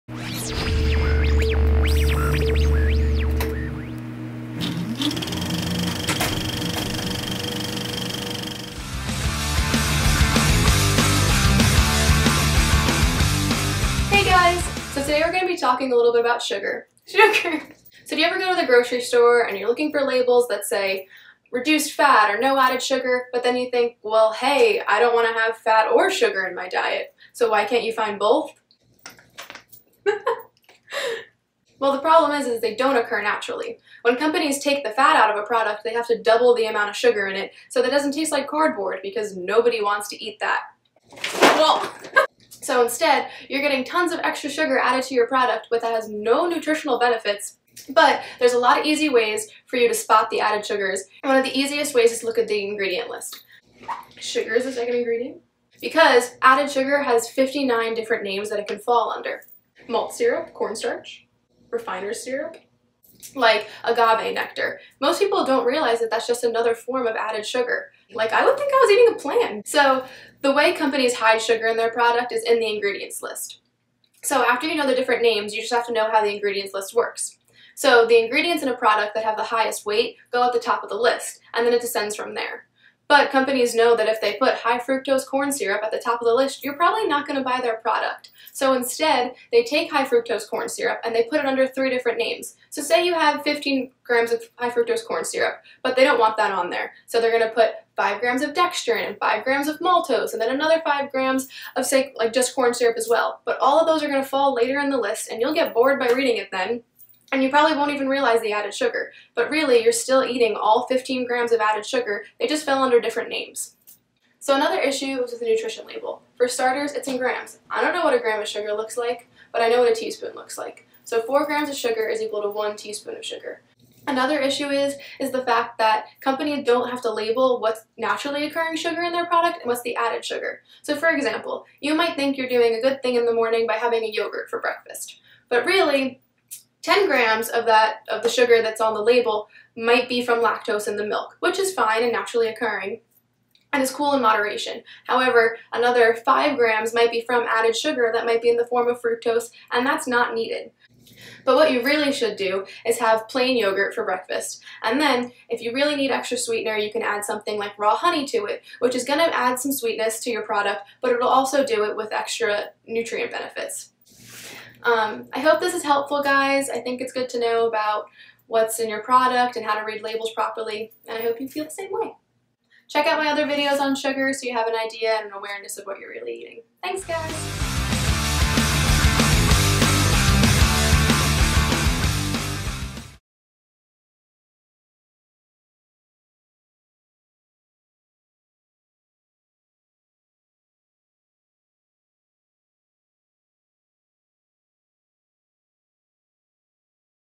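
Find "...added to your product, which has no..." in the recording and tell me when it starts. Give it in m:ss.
0:44.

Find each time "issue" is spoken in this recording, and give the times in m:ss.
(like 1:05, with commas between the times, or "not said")
1:54, 2:04.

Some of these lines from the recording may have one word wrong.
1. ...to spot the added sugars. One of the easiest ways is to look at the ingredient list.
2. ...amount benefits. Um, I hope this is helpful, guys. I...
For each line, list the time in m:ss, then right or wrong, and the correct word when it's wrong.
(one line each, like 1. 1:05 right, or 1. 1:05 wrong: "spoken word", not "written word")
1. 0:49 right
2. 2:42 wrong: "nutrient", not "amount".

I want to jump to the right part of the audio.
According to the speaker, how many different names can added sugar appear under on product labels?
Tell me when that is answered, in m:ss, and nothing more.
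0:57.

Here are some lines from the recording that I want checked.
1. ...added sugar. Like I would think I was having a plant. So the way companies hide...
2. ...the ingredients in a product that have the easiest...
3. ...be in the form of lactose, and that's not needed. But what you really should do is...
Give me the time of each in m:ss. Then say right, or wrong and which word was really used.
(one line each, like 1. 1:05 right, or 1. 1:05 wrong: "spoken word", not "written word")
1. 1:07 wrong: "eating", not "having"
2. 1:18 wrong: "highest", not "easiest"
3. 2:28 wrong: "fructose", not "lactose".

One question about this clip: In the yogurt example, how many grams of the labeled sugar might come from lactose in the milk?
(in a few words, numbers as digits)
10 grams.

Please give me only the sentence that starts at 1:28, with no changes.
So instead, they take high fructose corn syrup and they put it under three different names.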